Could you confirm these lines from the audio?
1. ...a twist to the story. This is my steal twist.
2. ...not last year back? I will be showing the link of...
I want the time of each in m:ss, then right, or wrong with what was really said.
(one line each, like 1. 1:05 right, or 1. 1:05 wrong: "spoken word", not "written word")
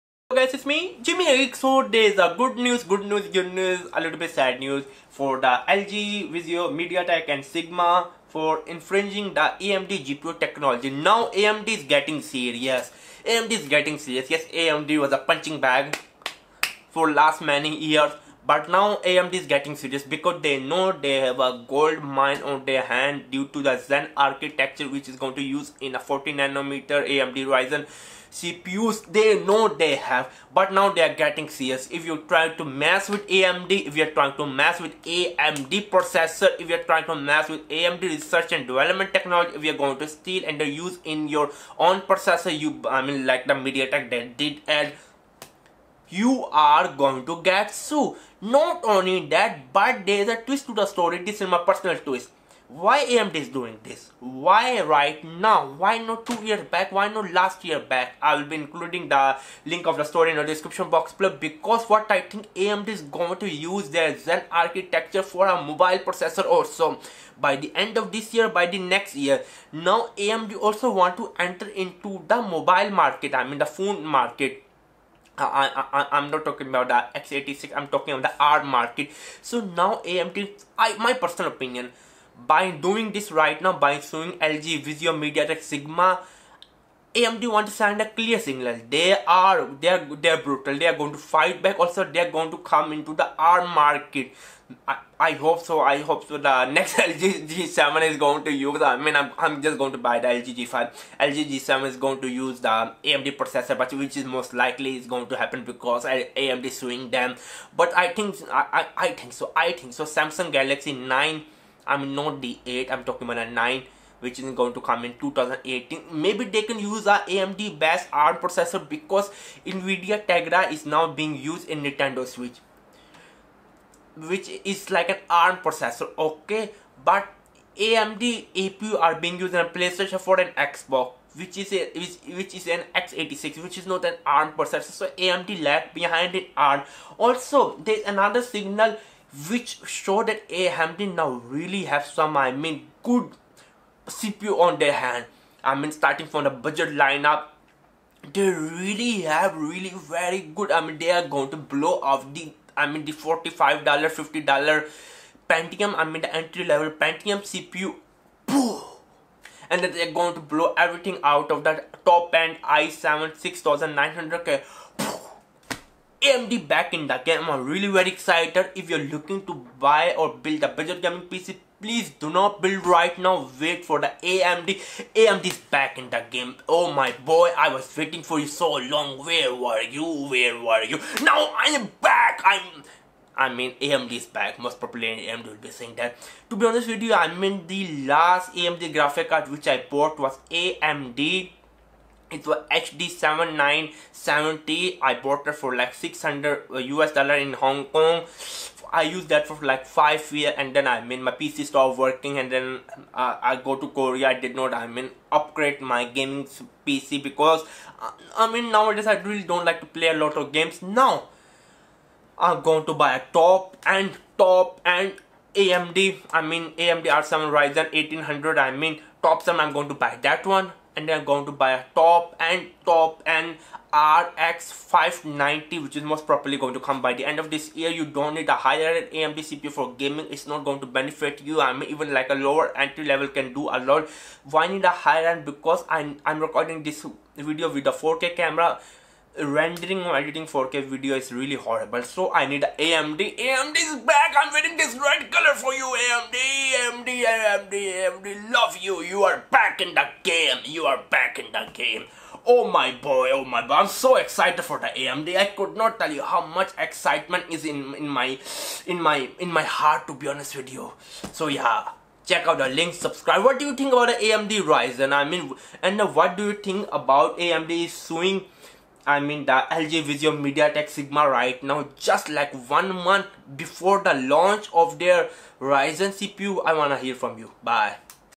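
1. 0:50 wrong: "personal", not "steal"
2. 0:57 wrong: "including", not "showing".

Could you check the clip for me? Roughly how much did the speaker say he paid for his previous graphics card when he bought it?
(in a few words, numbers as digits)
600 US dollars.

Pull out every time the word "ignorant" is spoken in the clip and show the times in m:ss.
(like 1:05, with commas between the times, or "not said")
not said.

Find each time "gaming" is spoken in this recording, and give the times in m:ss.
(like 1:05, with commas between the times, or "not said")
2:51, 3:26, 3:49.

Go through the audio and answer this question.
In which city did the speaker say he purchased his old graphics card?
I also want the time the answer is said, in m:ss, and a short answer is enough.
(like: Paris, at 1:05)
Hong Kong, at 3:17.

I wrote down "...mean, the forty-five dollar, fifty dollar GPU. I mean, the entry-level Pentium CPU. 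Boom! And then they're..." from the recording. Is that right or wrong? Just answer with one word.
wrong.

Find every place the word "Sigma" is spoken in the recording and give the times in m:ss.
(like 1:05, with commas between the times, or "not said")
0:07, 1:25, 4:30.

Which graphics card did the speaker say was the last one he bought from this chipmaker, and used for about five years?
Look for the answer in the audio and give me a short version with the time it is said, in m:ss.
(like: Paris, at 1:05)
HD7970, at 3:12.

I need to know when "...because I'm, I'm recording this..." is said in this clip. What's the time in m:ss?
3:55.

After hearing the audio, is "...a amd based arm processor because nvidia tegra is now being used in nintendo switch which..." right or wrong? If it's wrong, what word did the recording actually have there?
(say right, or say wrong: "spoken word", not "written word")
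right.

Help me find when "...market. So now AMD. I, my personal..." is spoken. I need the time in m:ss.
1:18.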